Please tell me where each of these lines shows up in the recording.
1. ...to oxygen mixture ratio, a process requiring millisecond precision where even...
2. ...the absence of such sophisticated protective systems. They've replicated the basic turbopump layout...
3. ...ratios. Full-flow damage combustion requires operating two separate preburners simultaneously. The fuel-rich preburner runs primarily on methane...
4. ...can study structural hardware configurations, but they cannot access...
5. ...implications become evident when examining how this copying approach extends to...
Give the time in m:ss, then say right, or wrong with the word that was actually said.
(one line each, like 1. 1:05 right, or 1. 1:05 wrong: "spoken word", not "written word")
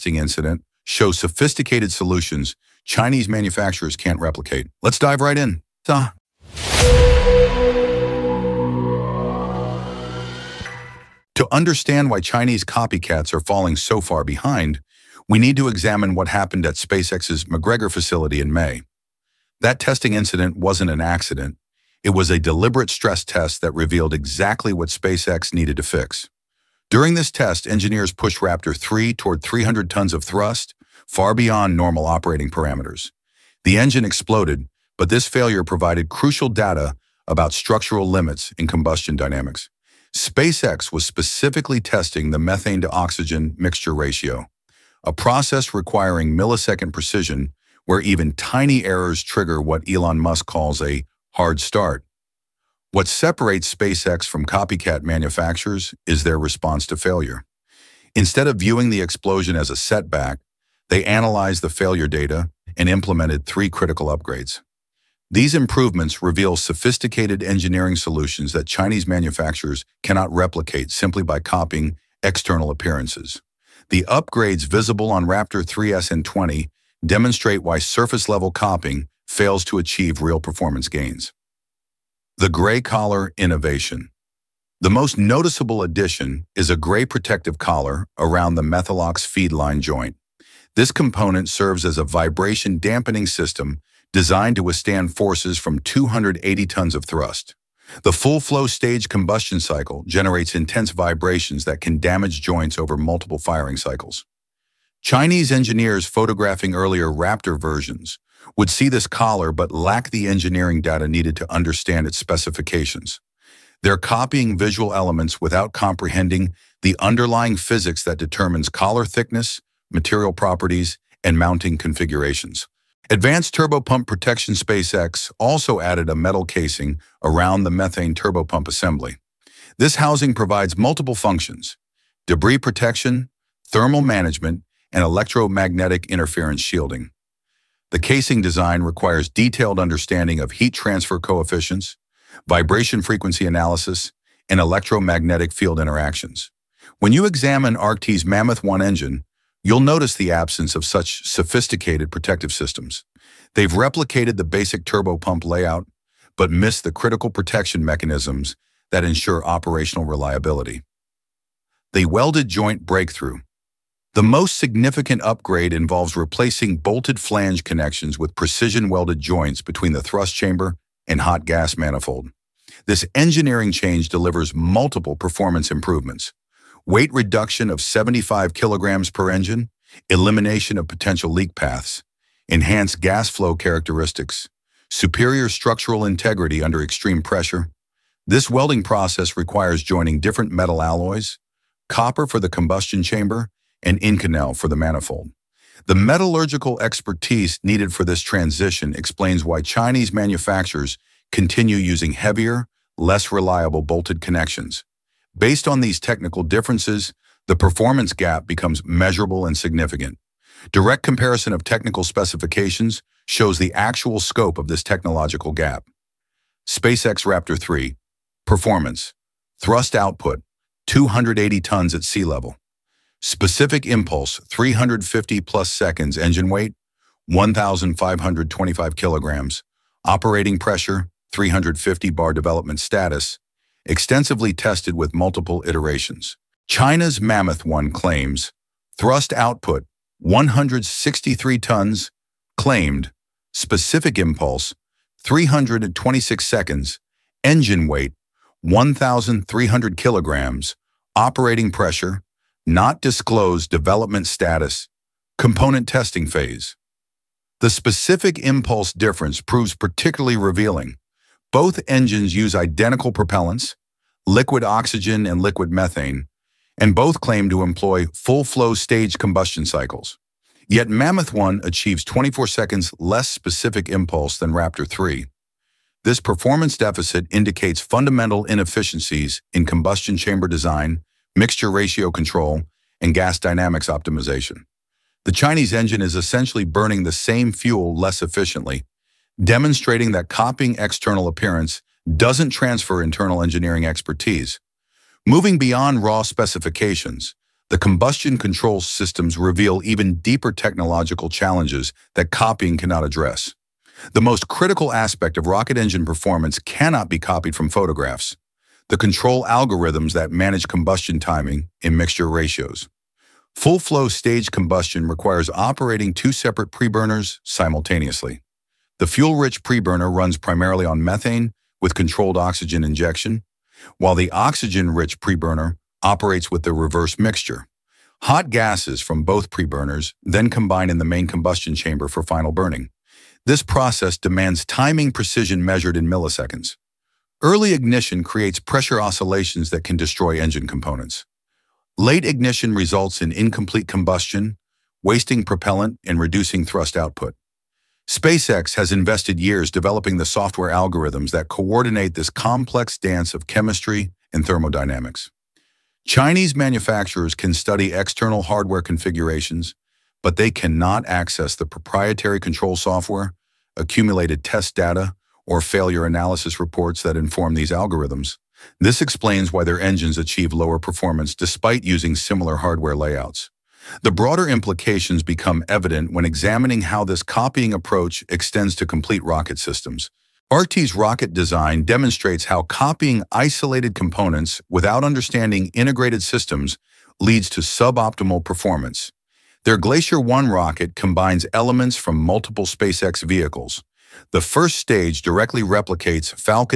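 1. 0:42 right
2. 2:30 right
3. 5:12 wrong: "stage", not "damage"
4. 5:57 wrong: "external", not "structural"
5. 6:14 right.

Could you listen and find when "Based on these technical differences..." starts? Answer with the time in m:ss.
3:25.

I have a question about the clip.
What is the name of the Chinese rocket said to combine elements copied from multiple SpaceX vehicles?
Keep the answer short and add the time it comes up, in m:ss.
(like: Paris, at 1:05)
Glacier 1, at 6:29.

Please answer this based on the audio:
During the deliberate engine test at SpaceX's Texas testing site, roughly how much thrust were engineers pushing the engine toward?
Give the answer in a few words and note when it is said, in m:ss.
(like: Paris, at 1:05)
300 tons, at 0:29.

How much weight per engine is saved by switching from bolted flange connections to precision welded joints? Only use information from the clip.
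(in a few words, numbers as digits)
75 kilograms.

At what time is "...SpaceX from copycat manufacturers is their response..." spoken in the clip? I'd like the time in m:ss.
0:53.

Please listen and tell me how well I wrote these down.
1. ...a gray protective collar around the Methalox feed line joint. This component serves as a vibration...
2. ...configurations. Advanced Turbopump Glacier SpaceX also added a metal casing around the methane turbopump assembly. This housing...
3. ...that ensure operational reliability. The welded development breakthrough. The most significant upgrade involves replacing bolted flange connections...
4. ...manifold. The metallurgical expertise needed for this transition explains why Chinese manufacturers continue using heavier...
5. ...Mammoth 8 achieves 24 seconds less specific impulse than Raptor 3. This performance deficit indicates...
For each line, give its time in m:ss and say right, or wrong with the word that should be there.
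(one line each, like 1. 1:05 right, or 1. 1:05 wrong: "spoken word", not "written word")
1. 1:26 right
2. 2:01 wrong: "Protection", not "Glacier"
3. 2:38 wrong: "joint", not "development"
4. 3:14 right
5. 4:30 wrong: "1", not "8".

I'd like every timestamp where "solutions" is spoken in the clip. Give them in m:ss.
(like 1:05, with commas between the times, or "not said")
0:01, 1:07.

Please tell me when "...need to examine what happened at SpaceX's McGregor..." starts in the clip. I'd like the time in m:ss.
0:15.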